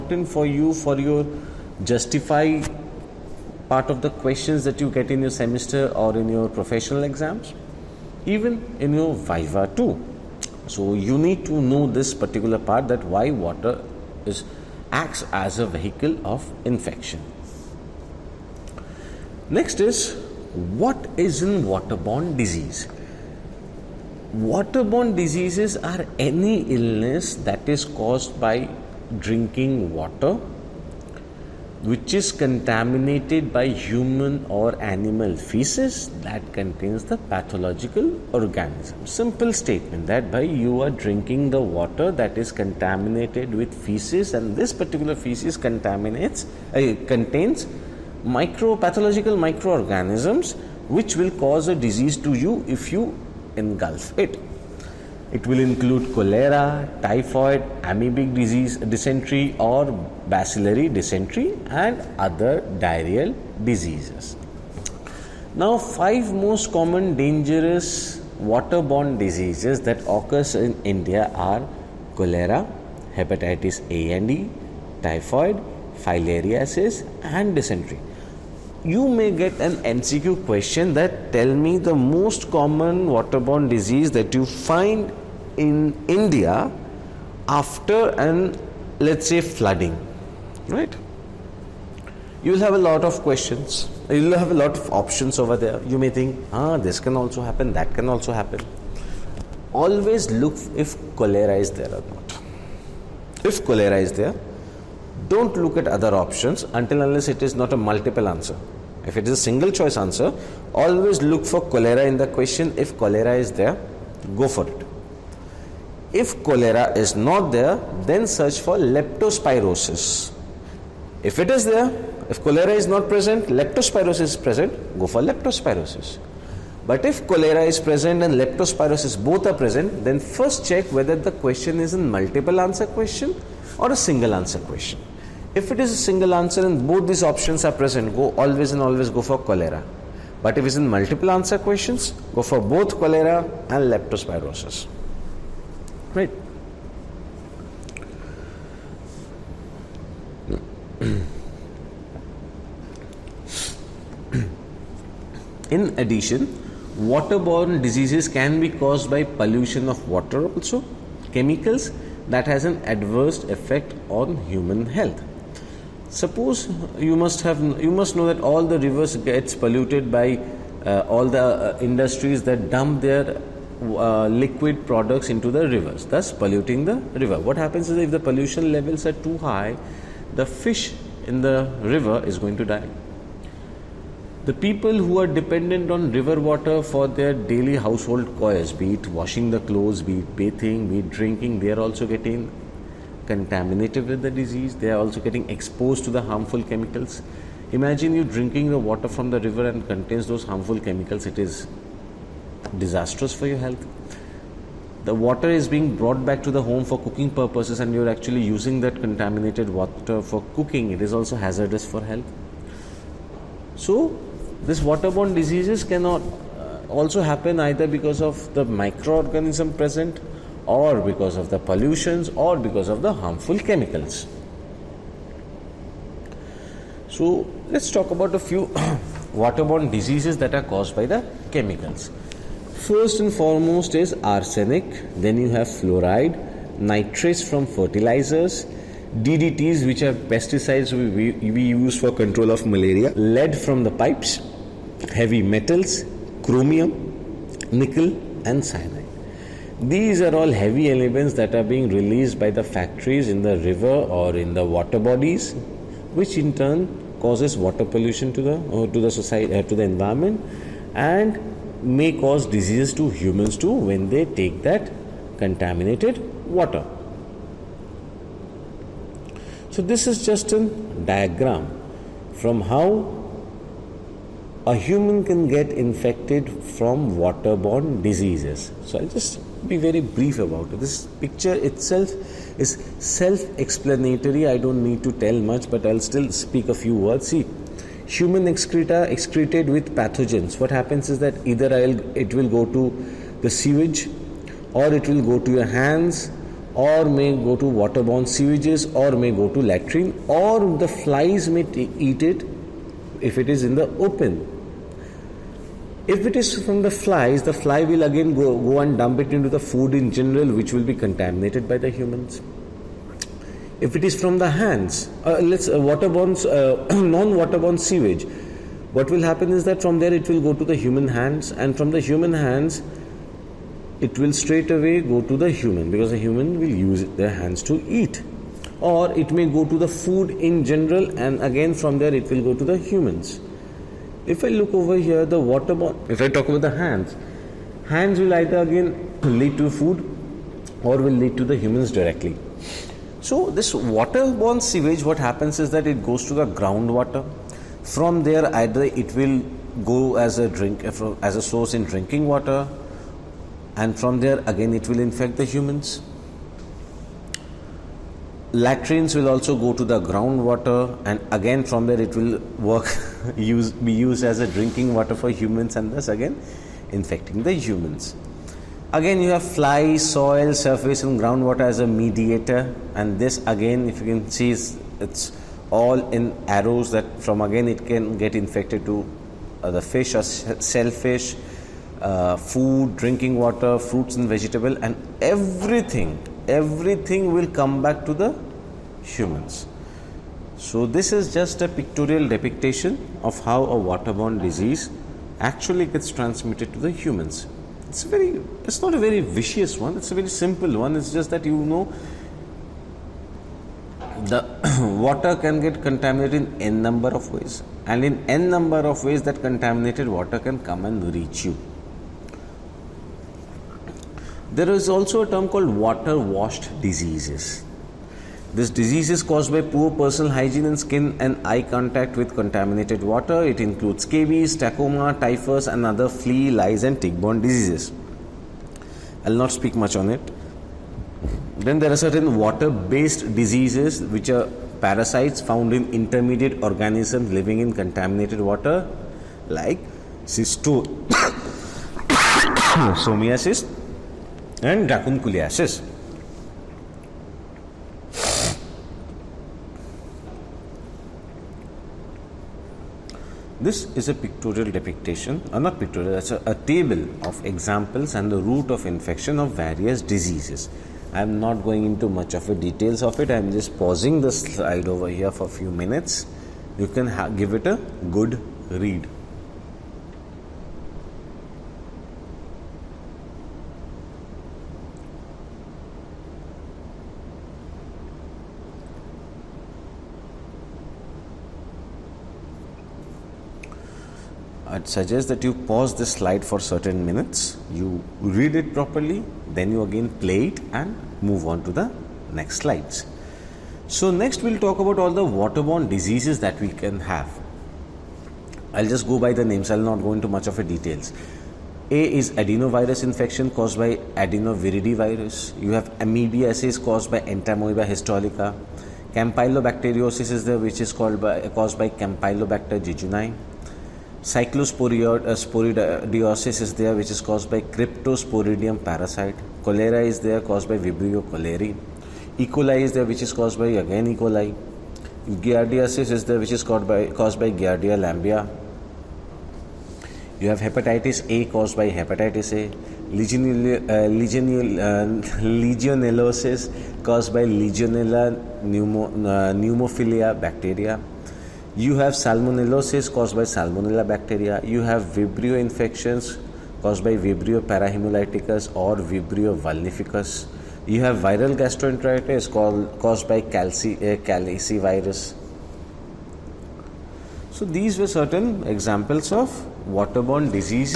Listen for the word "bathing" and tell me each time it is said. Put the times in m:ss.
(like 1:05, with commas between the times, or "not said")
3:10.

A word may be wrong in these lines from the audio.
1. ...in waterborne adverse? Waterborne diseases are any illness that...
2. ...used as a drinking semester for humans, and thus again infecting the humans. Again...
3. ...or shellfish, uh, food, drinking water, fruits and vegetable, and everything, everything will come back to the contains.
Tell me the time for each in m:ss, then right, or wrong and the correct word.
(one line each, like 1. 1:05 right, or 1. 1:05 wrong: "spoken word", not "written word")
1. 0:21 wrong: "disease", not "adverse"
2. 6:04 wrong: "water", not "semester"
3. 6:20 wrong: "humans", not "contains".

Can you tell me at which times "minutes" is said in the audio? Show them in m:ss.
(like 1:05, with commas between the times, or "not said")
7:45, 8:07.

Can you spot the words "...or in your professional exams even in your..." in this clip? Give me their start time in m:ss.
0:05.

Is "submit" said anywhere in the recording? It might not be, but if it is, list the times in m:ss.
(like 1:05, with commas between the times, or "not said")
not said.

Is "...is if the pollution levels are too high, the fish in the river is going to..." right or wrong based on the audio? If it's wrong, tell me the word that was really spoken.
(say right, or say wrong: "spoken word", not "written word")
right.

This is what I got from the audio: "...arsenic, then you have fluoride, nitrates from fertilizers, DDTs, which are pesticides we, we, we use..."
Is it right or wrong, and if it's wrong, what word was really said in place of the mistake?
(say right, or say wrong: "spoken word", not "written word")
right.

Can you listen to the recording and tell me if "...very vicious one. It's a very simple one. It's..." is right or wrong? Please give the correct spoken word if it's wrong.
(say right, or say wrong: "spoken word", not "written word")
right.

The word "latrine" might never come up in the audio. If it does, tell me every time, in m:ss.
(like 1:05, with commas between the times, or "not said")
4:59, 5:58.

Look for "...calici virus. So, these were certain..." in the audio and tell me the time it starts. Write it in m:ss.
9:14.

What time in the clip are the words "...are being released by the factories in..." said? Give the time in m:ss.
4:11.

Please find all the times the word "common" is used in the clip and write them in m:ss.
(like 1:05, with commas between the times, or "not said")
1:06, 1:22.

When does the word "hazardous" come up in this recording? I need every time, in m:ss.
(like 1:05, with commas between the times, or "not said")
3:31.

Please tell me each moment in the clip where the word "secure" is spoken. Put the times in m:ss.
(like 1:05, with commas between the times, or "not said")
not said.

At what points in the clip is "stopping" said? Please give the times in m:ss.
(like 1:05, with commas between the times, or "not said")
not said.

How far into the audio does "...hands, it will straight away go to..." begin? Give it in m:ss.
5:22.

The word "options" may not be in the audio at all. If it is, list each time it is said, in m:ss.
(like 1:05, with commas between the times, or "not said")
1:34, 1:46, 2:17.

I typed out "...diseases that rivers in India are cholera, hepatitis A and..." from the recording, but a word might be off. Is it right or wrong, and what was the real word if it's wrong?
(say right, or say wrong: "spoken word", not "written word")
wrong: "occurs", not "rivers".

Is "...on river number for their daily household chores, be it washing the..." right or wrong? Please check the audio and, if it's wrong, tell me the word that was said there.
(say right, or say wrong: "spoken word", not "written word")
wrong: "water", not "number".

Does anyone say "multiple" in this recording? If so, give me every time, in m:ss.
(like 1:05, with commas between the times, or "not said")
1:47, 2:12, 2:20.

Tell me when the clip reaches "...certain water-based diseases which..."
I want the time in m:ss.
7:11.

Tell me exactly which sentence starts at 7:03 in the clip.
It includes scabies, trachoma, typhus, and other flea, lice, and tick-borne diseases.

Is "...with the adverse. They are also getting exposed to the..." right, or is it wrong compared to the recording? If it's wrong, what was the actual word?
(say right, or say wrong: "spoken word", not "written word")
wrong: "disease", not "adverse".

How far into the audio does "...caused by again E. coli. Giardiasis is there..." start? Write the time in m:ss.
8:43.